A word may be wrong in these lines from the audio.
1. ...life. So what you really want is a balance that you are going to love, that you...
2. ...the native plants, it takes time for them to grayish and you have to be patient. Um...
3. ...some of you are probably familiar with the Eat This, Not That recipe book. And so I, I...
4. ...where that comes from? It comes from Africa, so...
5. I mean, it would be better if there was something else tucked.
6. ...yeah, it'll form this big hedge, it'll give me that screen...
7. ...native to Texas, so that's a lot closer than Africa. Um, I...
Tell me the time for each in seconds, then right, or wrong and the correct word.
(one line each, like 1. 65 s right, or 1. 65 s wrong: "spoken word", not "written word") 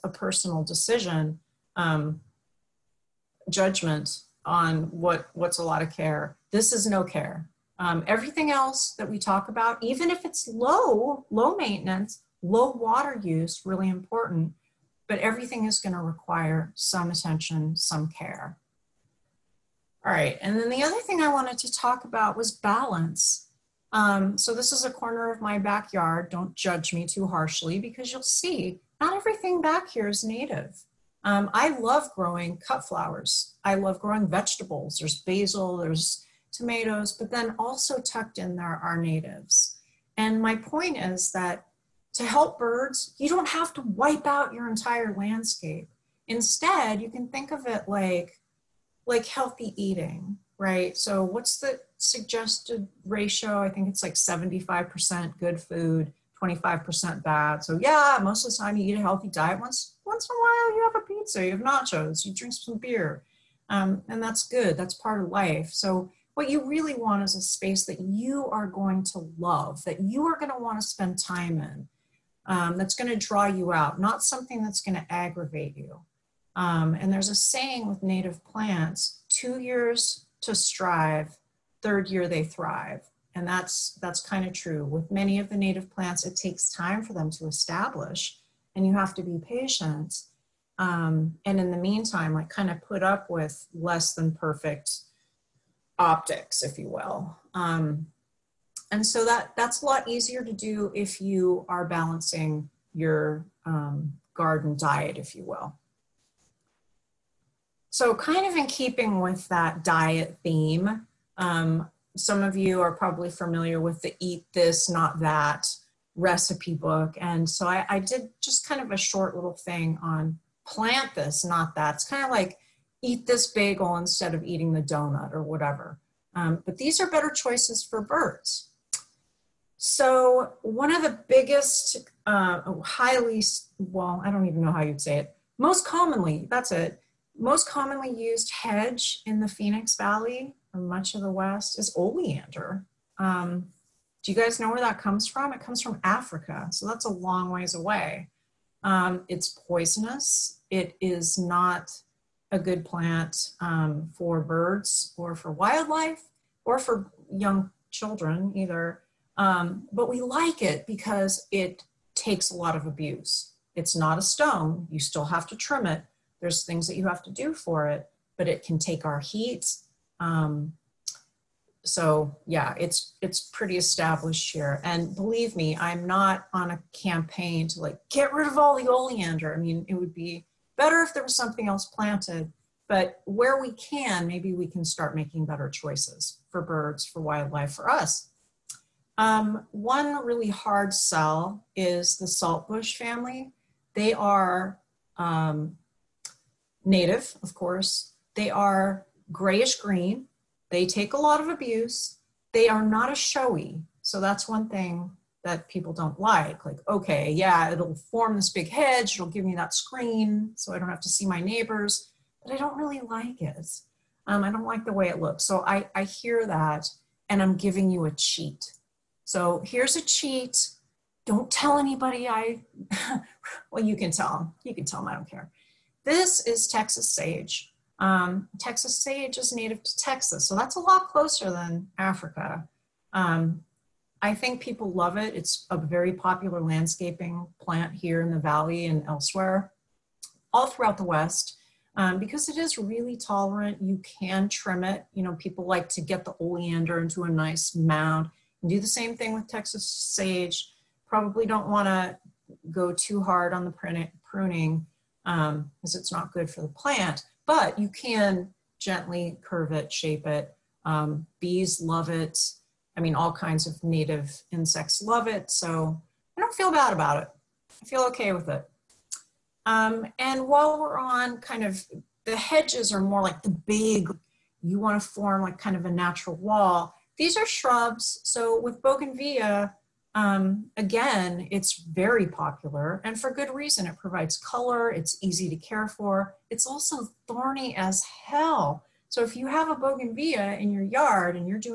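1. 65 s wrong: "space", not "balance"
2. 85 s wrong: "establish", not "grayish"
3. 112 s right
4. 144 s right
5. 179 s wrong: "planted", not "tucked"
6. 207 s right
7. 229 s right.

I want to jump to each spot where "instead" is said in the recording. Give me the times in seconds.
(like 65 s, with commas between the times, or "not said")
46 s, 123 s.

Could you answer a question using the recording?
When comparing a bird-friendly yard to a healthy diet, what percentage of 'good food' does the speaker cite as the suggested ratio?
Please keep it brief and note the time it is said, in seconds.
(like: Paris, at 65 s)
75%, at 54 s.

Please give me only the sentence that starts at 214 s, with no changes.
Um, I don't like the way it looks.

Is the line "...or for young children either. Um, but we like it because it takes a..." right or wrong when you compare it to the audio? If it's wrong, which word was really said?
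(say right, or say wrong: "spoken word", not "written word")
right.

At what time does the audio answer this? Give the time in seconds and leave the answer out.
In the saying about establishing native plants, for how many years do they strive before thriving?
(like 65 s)
79 s.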